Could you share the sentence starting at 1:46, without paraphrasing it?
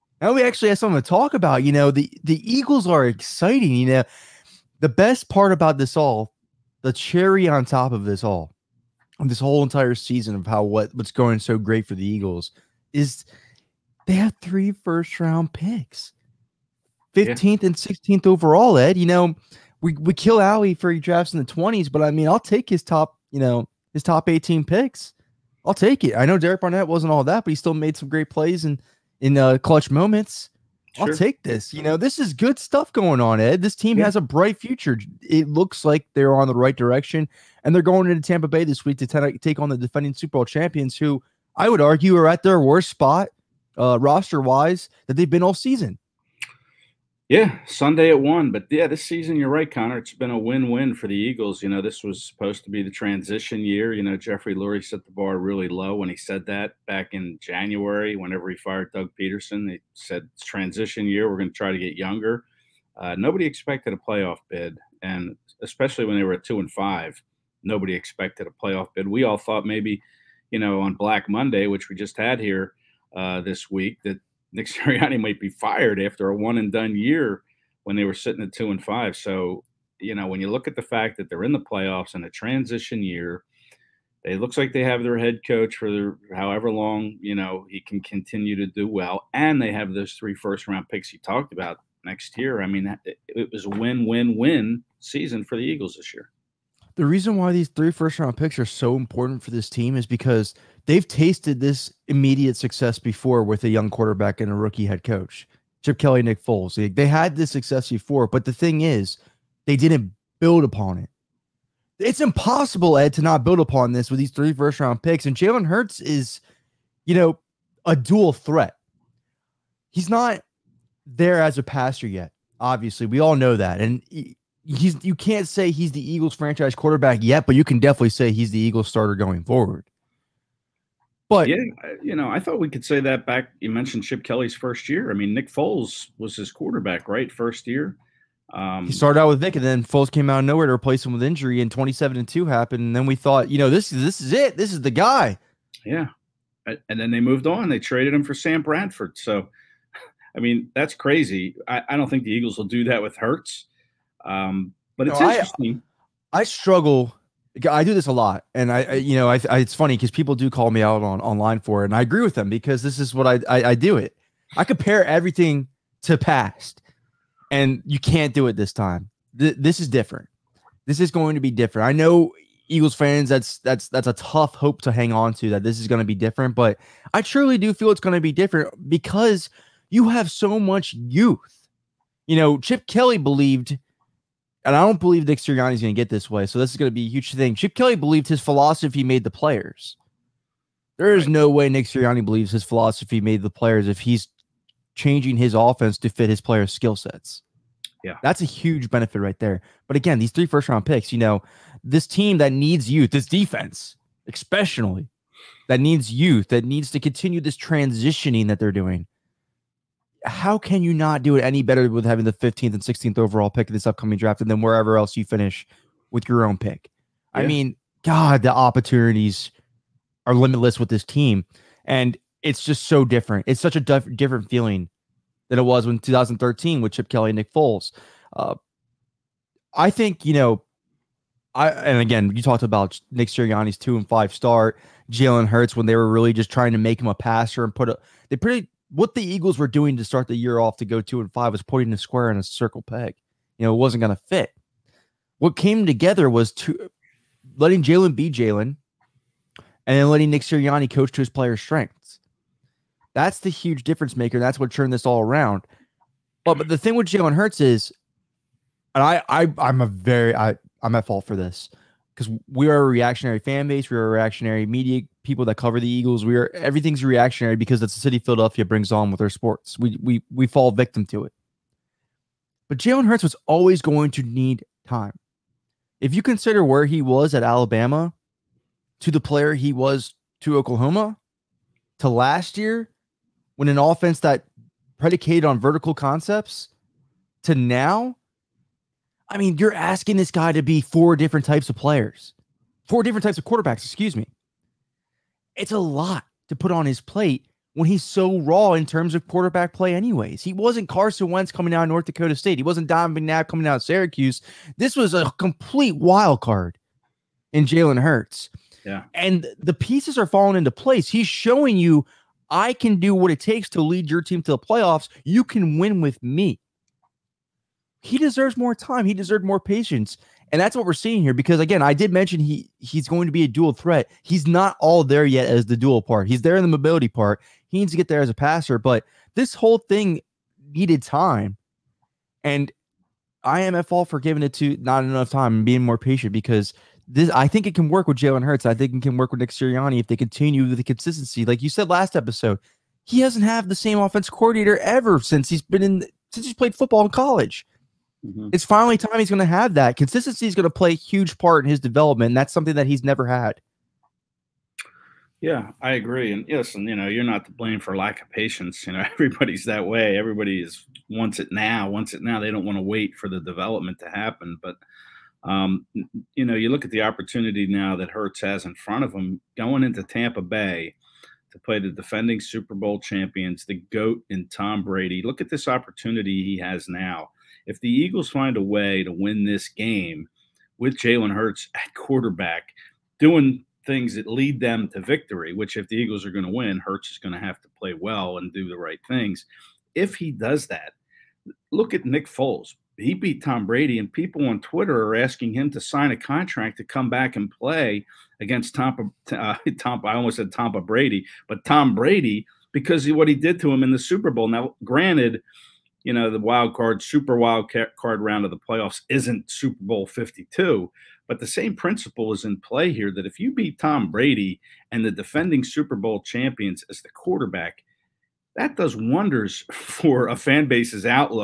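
They, they had this success before, but the thing is, they didn't build upon it.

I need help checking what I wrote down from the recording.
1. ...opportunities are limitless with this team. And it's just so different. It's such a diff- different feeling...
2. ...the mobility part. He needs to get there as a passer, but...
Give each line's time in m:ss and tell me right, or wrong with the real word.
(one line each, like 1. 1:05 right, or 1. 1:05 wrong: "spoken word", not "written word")
1. 3:38 right
2. 5:26 right.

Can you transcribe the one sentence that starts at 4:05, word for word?
What came together was to letting Jalen be Jalen, and then letting Nick Sirianni coach to his players' strengths.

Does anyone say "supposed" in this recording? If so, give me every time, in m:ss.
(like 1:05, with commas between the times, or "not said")
0:52.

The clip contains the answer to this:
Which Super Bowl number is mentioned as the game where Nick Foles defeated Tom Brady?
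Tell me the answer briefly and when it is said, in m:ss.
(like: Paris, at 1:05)
Super Bowl 52, at 6:49.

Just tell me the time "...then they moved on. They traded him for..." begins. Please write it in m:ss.
2:26.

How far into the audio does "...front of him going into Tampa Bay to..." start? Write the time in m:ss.
6:08.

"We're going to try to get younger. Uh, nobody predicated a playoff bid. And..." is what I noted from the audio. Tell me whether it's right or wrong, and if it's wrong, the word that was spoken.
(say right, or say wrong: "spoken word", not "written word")
wrong: "expected", not "predicated".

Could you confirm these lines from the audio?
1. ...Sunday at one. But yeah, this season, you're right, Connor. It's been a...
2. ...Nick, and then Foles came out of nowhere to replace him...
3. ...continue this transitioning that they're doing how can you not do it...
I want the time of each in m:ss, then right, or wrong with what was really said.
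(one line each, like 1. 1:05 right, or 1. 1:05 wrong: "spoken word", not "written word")
1. 0:47 right
2. 2:19 right
3. 3:26 right.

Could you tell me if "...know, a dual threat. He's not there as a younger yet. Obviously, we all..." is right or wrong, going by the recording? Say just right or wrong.
wrong.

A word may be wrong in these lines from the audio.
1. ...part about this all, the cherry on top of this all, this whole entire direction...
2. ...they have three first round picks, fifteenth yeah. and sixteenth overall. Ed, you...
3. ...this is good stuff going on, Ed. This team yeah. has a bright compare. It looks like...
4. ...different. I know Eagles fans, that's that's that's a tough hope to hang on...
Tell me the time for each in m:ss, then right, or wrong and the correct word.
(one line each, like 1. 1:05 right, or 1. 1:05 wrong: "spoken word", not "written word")
1. 0:05 wrong: "season", not "direction"
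2. 0:14 right
3. 0:31 wrong: "future", not "compare"
4. 2:51 right.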